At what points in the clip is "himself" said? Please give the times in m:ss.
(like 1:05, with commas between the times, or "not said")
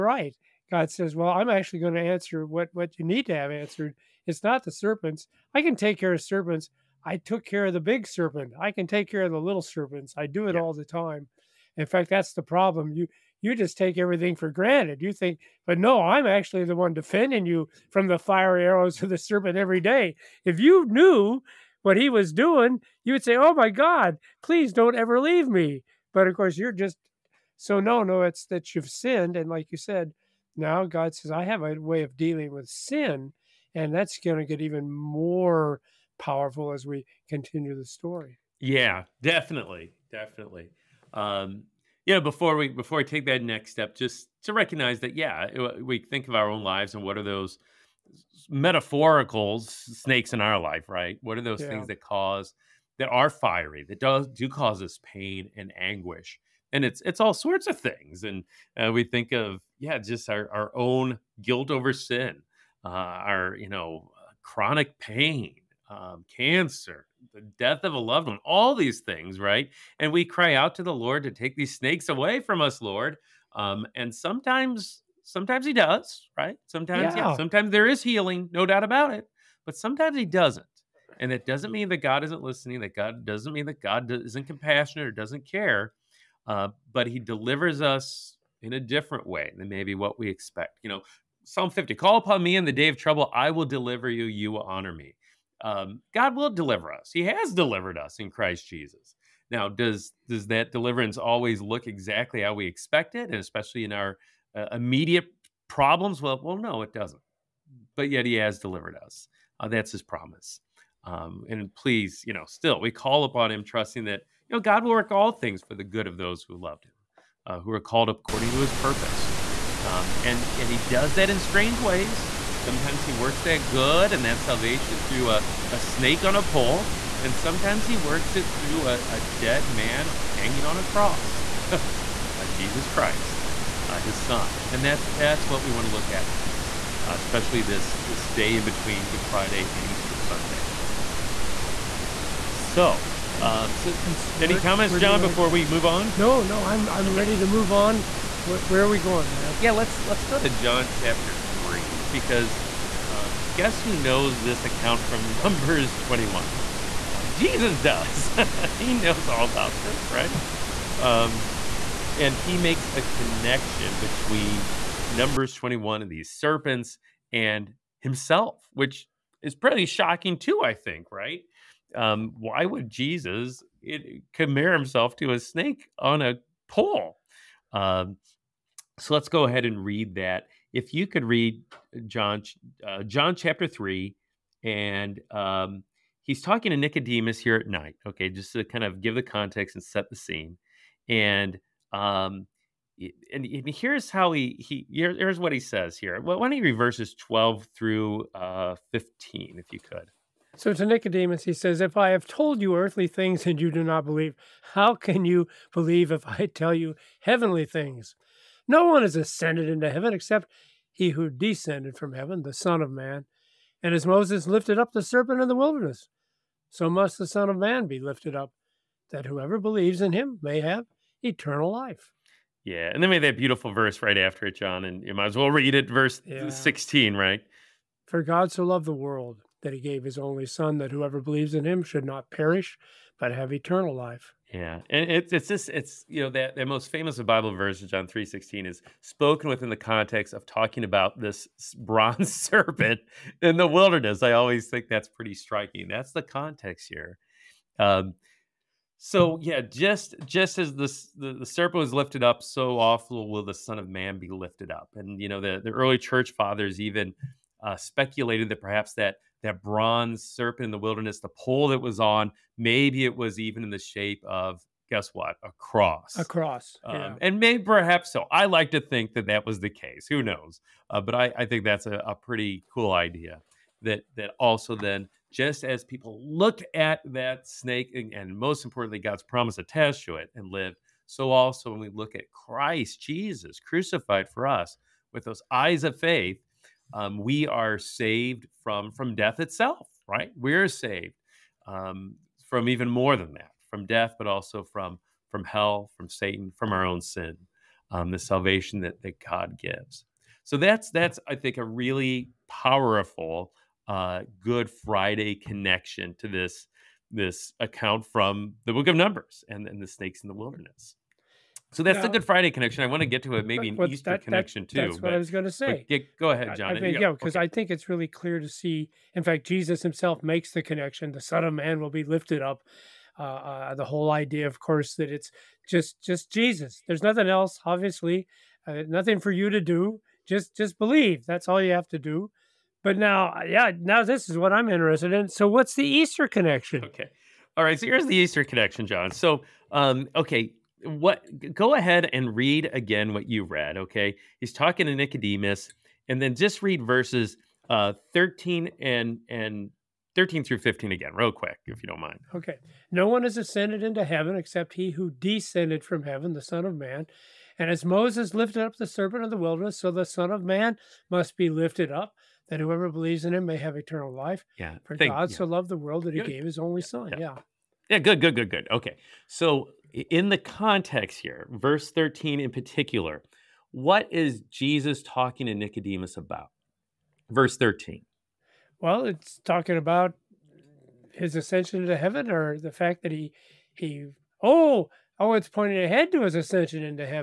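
2:48, 2:54, 5:19.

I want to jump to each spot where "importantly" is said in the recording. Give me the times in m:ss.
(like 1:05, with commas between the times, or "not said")
4:38.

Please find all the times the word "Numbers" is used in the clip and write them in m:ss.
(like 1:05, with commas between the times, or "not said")
2:35, 2:45, 5:08.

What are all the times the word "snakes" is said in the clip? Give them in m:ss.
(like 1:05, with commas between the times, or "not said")
0:49, 1:11, 2:05, 2:55, 4:37, 5:09.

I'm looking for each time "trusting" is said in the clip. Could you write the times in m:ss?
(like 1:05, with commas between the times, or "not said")
1:53.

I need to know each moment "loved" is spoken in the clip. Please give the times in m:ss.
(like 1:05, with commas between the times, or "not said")
1:07, 1:56, 3:48, 6:05.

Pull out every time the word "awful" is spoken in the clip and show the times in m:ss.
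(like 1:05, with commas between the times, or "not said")
4:12.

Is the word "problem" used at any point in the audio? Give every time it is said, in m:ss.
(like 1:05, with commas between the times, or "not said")
0:12, 1:45.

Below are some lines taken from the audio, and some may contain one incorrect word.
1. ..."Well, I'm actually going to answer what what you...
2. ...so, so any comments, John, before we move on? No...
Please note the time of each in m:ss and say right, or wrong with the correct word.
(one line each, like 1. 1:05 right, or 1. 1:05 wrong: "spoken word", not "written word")
1. 0:01 right
2. 2:23 right.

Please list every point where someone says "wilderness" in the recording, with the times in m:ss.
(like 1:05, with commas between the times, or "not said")
3:35, 4:03, 4:20, 5:10, 5:59.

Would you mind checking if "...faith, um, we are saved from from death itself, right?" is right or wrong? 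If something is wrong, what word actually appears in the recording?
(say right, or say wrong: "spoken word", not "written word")
right.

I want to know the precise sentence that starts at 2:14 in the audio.
And that's, that's what we want to look at next, uh, especially this, this day in between Good Friday and Easter Sunday.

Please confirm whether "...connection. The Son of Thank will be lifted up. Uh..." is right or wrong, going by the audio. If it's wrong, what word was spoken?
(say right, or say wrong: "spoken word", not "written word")
wrong: "Man", not "Thank".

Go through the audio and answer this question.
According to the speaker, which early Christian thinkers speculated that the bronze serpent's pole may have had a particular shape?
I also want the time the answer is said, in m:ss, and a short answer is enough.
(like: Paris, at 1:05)
Early church fathers, at 4:15.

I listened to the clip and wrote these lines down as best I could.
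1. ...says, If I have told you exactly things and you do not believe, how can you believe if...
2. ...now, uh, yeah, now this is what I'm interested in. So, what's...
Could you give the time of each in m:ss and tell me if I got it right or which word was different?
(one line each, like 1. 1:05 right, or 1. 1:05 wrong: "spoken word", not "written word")
1. 3:21 wrong: "earthly", not "exactly"
2. 5:32 right.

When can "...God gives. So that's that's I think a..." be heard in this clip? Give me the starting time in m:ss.
4:59.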